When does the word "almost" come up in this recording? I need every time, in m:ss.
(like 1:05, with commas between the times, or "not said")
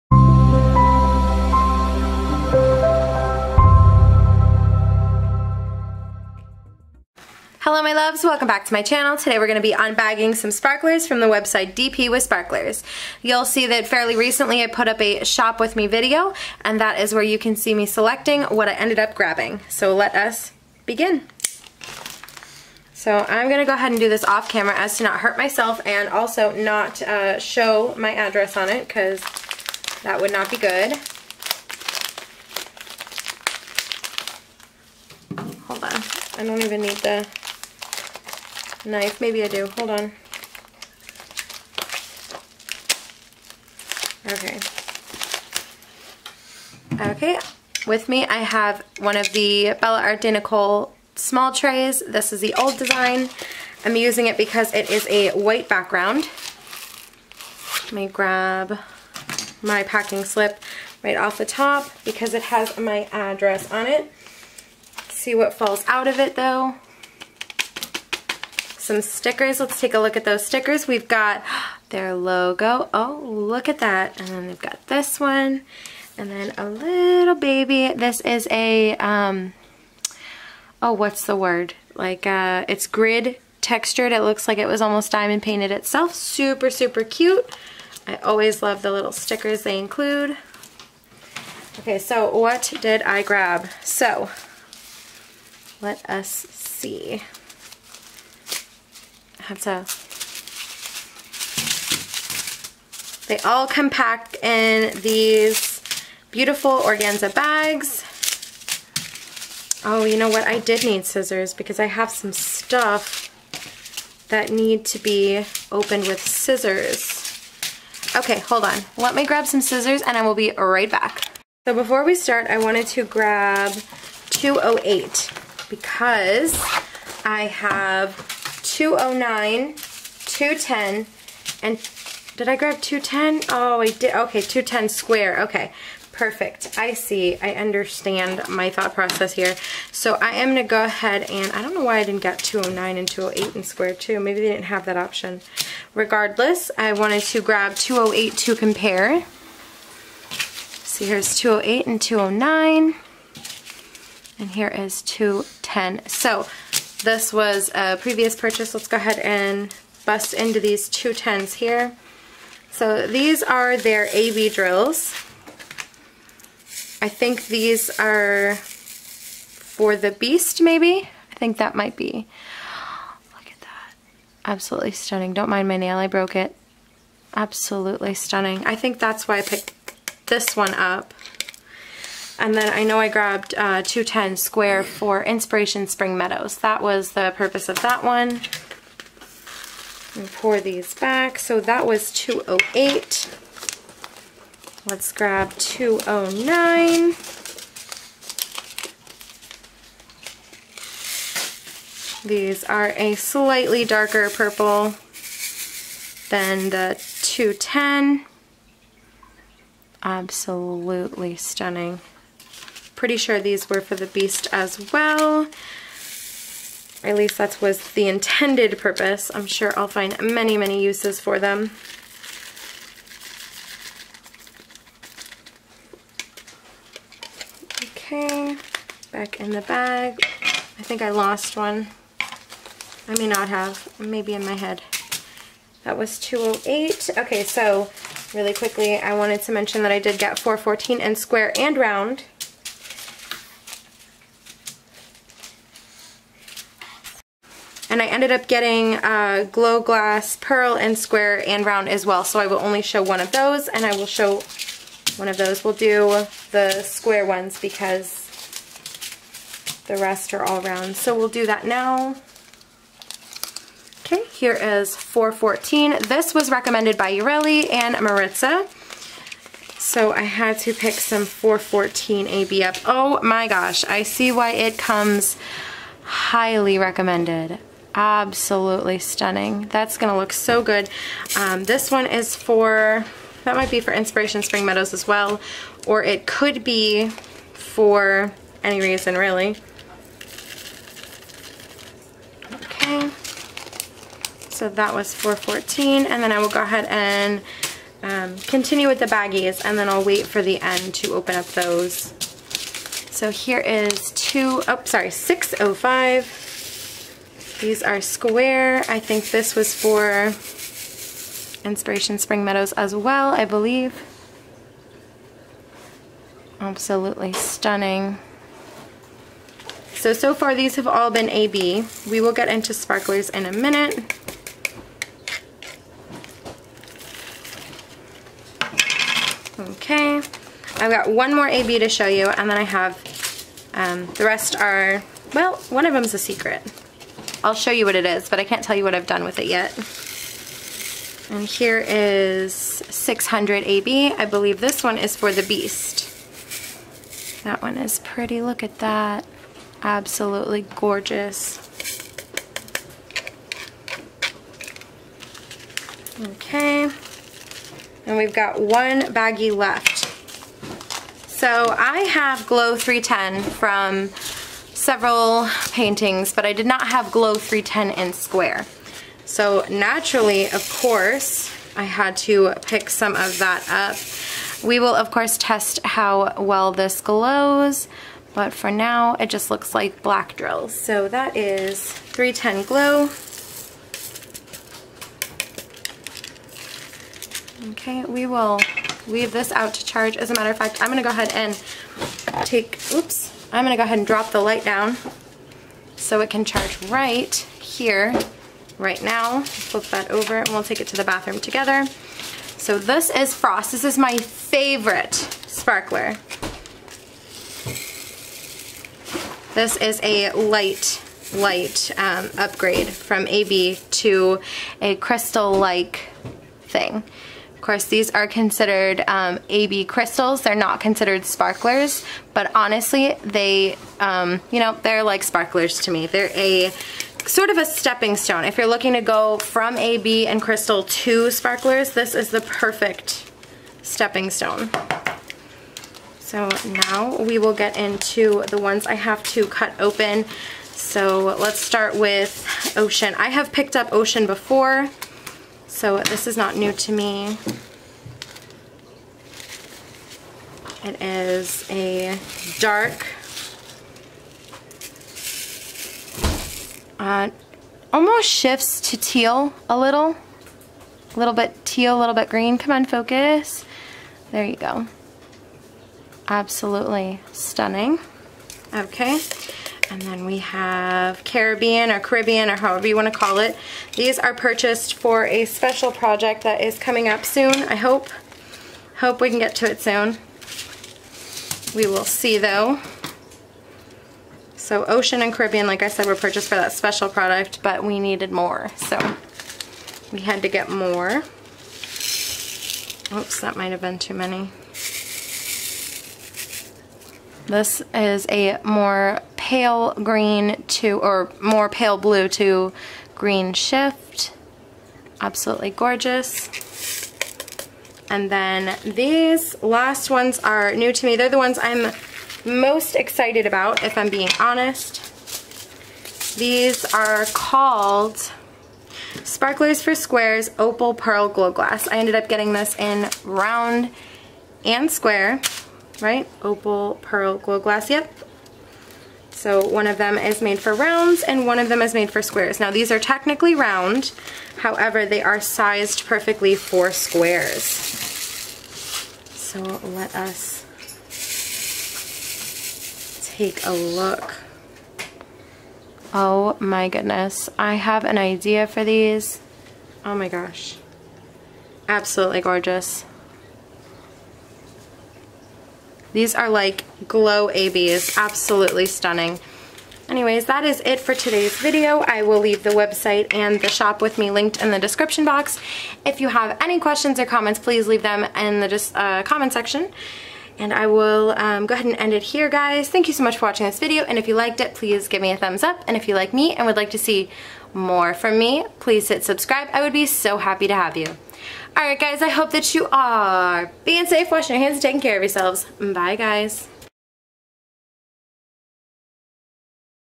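1:24, 7:37.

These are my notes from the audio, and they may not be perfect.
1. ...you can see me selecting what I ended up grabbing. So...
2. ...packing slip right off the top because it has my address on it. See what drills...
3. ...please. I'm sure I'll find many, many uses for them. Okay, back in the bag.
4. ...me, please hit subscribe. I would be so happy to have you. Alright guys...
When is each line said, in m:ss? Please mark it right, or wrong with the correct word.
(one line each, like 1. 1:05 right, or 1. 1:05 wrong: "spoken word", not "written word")
1. 0:17 right
2. 0:59 wrong: "falls", not "drills"
3. 3:38 wrong: "purpose", not "please"
4. 9:38 right.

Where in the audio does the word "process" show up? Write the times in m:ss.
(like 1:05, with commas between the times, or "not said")
2:18.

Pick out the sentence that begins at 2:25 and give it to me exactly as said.
Regardless, I wanted to grab 208 to compare.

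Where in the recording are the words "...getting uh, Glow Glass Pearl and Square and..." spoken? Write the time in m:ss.
4:08.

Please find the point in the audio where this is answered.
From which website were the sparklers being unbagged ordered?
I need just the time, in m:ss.
0:11.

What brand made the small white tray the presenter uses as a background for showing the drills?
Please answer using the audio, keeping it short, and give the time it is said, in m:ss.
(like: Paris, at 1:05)
Bella Art de Nicole, at 0:49.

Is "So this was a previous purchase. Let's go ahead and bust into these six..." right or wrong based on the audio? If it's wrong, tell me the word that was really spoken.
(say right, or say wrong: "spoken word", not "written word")
wrong: "two", not "six".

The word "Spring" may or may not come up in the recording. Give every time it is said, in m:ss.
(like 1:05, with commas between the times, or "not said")
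3:05, 4:44, 5:12.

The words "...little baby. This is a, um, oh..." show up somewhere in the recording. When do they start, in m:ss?
1:16.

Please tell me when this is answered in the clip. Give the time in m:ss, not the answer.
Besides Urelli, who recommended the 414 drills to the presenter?
4:27.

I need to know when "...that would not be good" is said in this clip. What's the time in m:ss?
0:30.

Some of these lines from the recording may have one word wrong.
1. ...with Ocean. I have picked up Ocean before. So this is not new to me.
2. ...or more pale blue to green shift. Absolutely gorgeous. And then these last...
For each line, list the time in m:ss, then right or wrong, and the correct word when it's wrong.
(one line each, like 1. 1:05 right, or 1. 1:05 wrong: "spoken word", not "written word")
1. 7:21 right
2. 8:20 right.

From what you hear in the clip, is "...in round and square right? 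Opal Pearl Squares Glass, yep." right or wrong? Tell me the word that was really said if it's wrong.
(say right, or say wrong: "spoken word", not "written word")
wrong: "Glow", not "Squares".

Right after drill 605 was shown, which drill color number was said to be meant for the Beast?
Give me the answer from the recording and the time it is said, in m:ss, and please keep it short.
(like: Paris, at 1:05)
600, at 5:42.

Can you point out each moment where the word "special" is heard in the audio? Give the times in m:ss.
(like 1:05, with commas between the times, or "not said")
7:55, 8:06.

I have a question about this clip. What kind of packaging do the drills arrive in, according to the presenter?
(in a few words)
organza bags.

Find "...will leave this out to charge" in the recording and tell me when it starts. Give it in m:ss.
6:28.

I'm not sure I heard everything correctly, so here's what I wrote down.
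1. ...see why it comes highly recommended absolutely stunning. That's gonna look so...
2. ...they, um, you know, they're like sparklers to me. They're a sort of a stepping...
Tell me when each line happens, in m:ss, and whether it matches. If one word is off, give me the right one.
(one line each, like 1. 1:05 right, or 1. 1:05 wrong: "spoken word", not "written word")
1. 4:34 right
2. 7:03 right.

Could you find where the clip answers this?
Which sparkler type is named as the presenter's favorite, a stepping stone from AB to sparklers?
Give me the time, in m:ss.
6:43.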